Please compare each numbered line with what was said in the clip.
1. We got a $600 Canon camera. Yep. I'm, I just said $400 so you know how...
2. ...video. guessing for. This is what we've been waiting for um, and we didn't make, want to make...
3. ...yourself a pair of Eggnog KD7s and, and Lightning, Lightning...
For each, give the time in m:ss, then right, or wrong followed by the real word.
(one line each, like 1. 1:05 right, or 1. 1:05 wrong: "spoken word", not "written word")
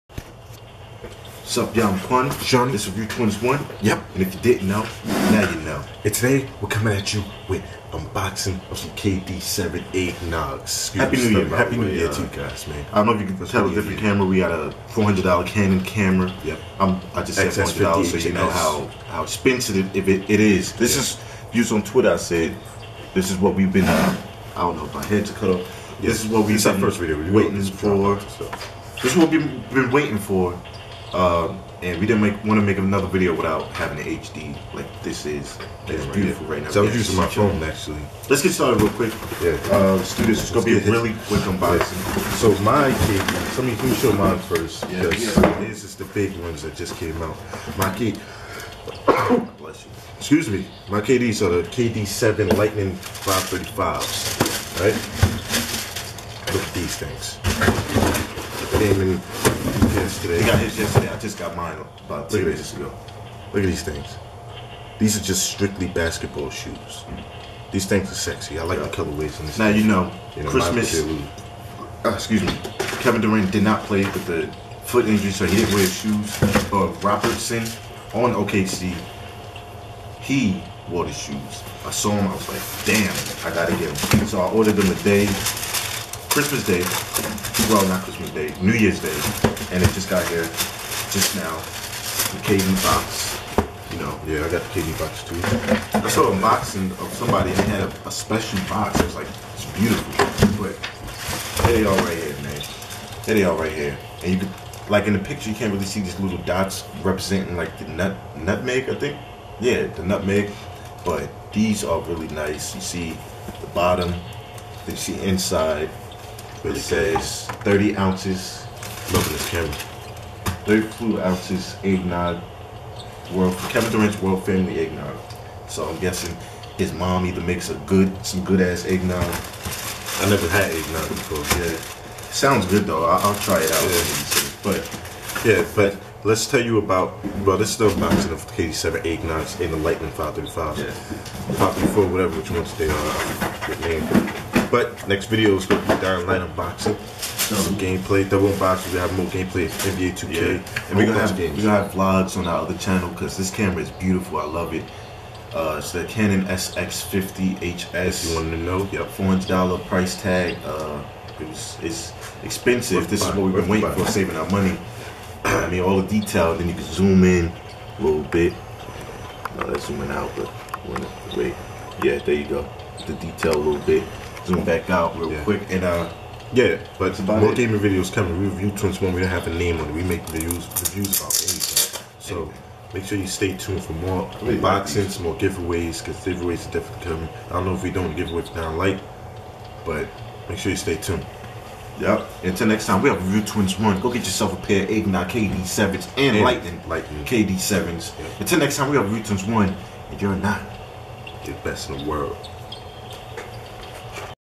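1. 0:14 wrong: "400", not "600"
2. 0:26 wrong: "waiting", not "guessing"
3. 3:14 right.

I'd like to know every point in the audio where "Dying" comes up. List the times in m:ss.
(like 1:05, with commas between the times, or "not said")
2:26, 3:08.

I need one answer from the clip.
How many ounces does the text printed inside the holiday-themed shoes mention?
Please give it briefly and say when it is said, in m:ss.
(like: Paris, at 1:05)
30 ounces, at 1:57.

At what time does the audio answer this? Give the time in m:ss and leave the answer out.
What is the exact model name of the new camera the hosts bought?
2:36.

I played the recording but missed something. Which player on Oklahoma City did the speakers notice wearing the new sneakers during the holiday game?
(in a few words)
Robertson.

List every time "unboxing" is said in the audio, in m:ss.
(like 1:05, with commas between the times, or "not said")
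0:07, 0:41, 2:17, 2:26, 3:04.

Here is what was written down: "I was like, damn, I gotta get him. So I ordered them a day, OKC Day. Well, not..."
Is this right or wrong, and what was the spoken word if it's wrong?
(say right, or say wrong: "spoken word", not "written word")
wrong: "Christmas", not "OKC".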